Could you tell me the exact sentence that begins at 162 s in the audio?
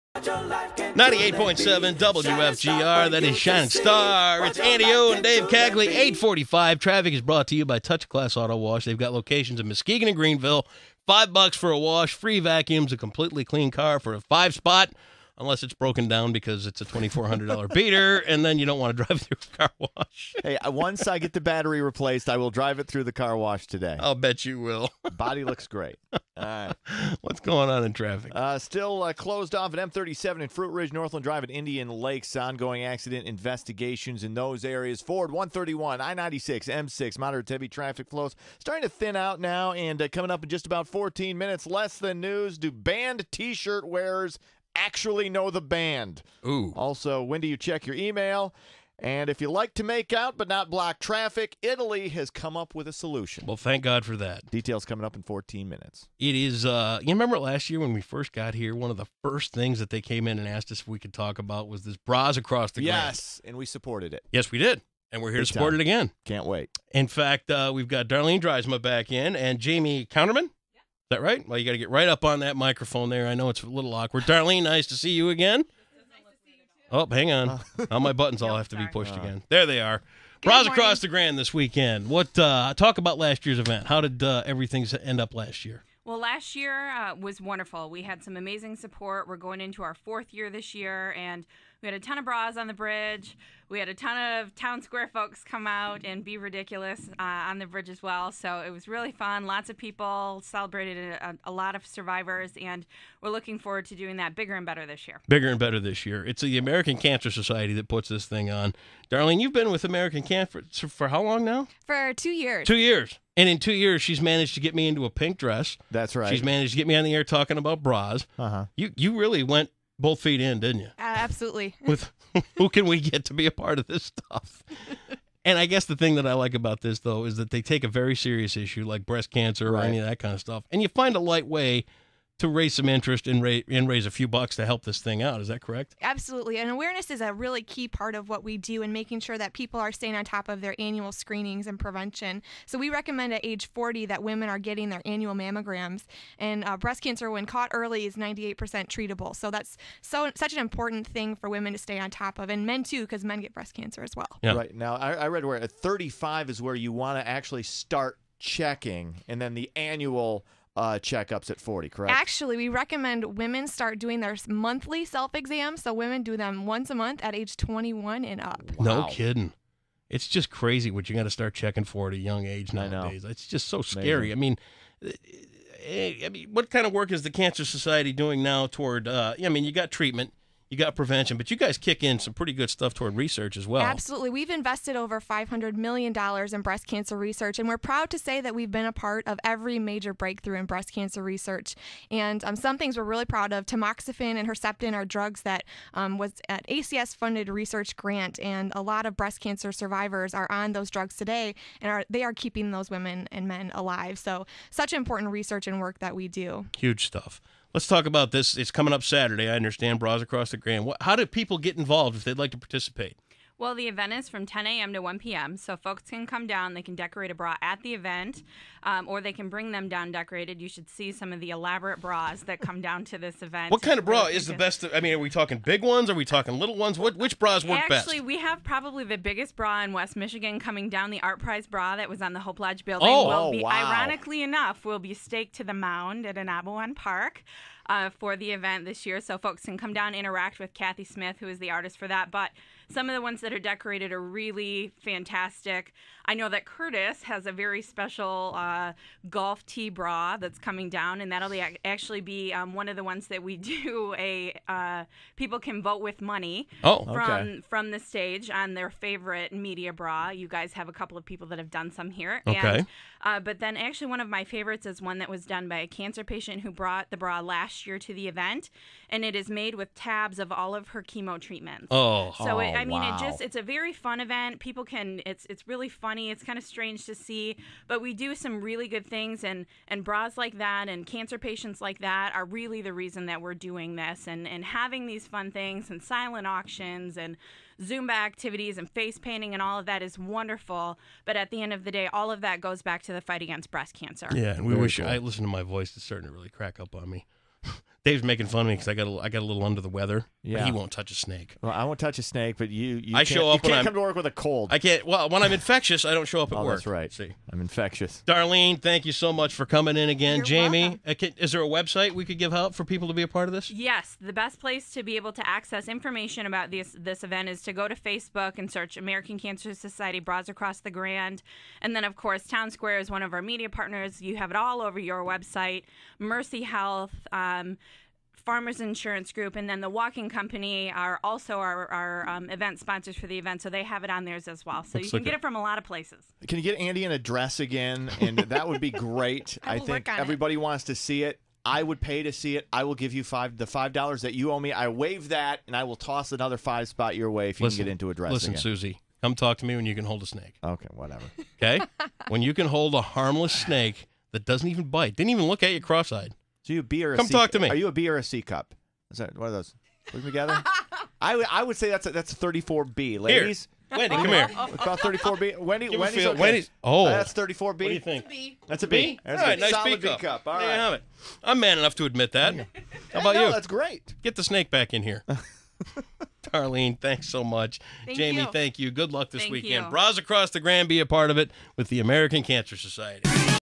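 Actually, we recommend women start doing their monthly self exams.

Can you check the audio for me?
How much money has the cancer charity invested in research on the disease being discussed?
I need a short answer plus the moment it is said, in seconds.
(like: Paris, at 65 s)
$500 million, at 185 s.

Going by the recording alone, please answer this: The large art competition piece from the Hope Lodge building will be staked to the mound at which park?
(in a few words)
Ah-Nab-Awen Park.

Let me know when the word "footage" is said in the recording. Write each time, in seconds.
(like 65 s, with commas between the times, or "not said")
not said.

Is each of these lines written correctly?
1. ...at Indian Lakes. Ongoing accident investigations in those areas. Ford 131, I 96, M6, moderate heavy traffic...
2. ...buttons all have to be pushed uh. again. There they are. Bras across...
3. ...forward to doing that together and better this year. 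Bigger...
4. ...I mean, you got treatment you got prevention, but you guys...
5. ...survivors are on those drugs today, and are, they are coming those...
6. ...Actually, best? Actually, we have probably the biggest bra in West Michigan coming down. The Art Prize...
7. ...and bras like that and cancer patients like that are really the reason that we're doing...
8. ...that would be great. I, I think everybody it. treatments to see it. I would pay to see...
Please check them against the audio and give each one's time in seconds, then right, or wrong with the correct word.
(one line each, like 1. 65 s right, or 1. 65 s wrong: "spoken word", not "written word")
1. 31 s right
2. 78 s right
3. 103 s wrong: "bigger", not "together"
4. 179 s right
5. 199 s wrong: "keeping", not "coming"
6. 227 s right
7. 279 s right
8. 338 s wrong: "wants", not "treatments".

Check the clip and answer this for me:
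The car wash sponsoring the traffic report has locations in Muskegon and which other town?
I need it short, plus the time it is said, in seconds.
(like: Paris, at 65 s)
Greenville, at 10 s.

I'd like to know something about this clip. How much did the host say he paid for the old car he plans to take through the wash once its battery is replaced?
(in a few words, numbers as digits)
$2,400.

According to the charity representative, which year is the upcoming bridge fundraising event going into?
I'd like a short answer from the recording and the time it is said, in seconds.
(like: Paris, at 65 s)
fourth year, at 89 s.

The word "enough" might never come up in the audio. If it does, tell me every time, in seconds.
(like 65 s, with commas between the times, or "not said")
234 s, 371 s.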